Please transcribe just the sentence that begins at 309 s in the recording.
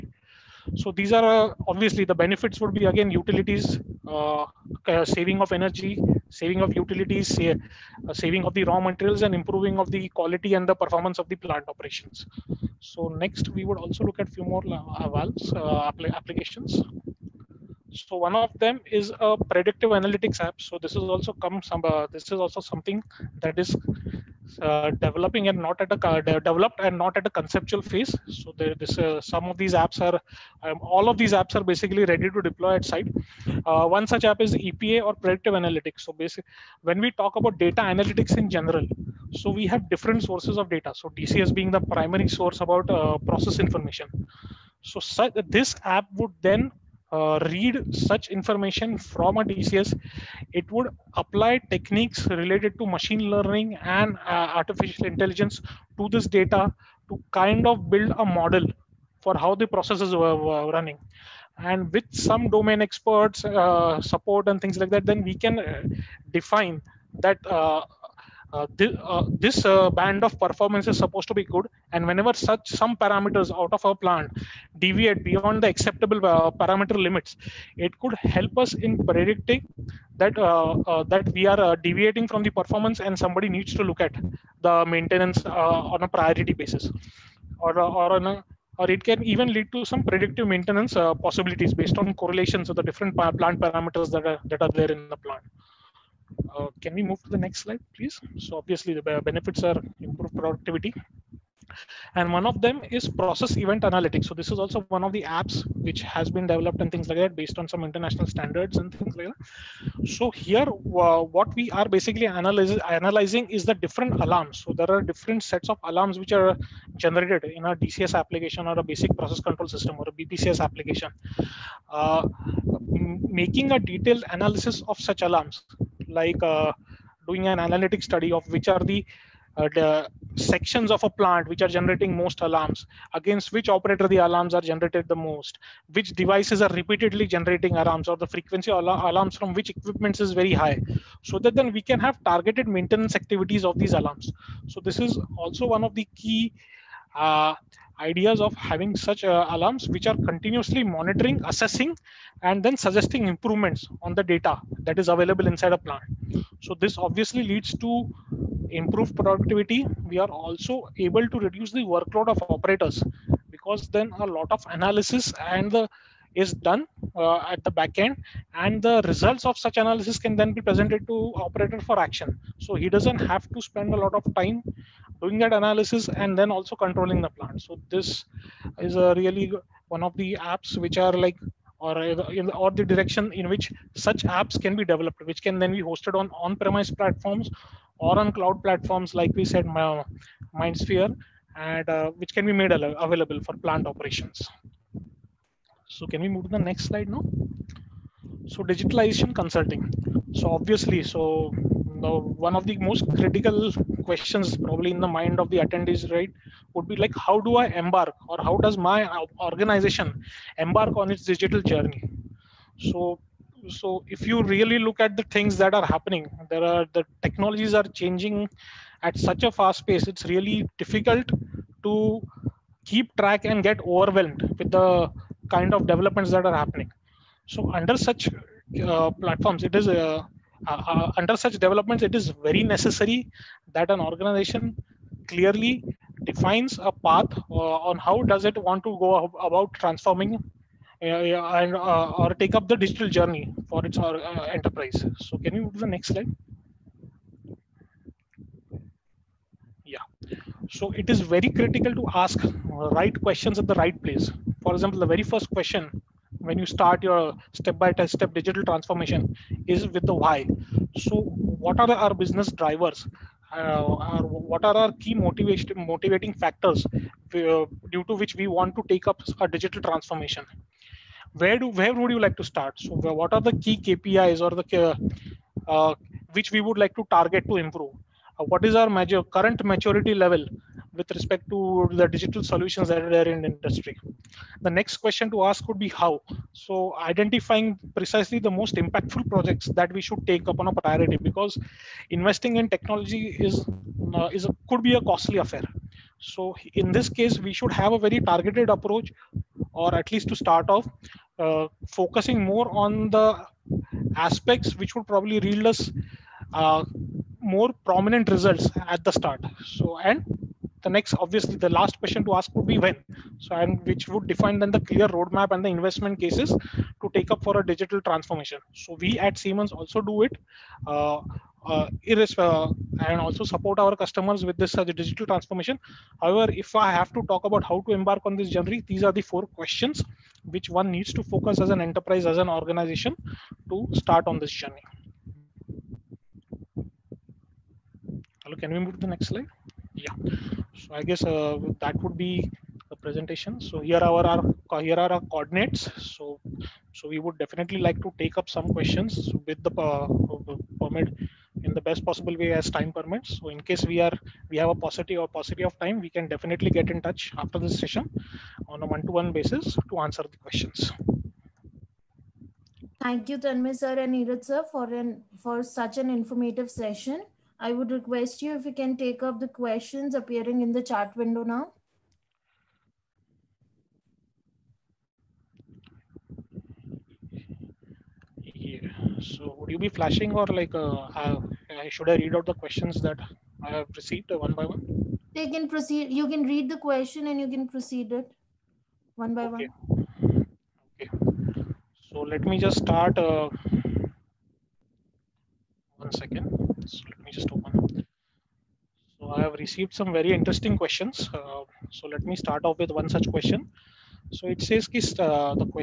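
So, and the next, obviously, the last question to ask would be when.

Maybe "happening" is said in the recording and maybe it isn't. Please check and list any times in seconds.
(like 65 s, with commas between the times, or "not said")
215 s, 226 s.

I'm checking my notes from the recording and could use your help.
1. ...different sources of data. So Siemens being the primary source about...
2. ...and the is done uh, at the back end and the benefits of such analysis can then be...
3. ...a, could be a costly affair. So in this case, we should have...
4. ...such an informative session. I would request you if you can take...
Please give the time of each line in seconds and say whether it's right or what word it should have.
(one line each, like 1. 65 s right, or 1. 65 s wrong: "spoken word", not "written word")
1. 39 s wrong: "DCS", not "Siemens"
2. 165 s wrong: "results", not "benefits"
3. 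294 s right
4. 365 s right.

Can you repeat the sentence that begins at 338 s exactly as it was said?
Hello, can we move to the next slide?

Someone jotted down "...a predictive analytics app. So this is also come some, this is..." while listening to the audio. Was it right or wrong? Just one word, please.
right.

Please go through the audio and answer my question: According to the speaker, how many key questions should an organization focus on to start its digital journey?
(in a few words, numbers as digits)
4.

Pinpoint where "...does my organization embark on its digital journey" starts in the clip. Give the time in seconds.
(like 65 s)
208 s.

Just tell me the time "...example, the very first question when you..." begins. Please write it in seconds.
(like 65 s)
254 s.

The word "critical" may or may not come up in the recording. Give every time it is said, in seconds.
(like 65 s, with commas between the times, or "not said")
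203 s, 251 s.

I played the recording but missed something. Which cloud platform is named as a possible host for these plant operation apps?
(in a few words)
MindSphere.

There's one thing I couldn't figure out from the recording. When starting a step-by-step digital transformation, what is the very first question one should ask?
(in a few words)
Why.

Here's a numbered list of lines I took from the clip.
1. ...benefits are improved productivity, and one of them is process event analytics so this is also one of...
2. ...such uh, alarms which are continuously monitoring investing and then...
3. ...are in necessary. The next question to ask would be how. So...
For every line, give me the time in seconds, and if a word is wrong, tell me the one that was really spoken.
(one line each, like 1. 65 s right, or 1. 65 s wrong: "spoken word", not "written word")
1. 99 s right
2. 148 s wrong: "assessing", not "investing"
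3. 283 s wrong: "industry", not "necessary".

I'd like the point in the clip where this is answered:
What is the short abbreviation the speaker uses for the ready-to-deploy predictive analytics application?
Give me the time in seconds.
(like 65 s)
34 s.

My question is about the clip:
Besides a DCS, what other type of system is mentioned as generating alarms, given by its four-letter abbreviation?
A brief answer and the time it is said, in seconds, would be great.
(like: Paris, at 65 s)
BPCS, at 120 s.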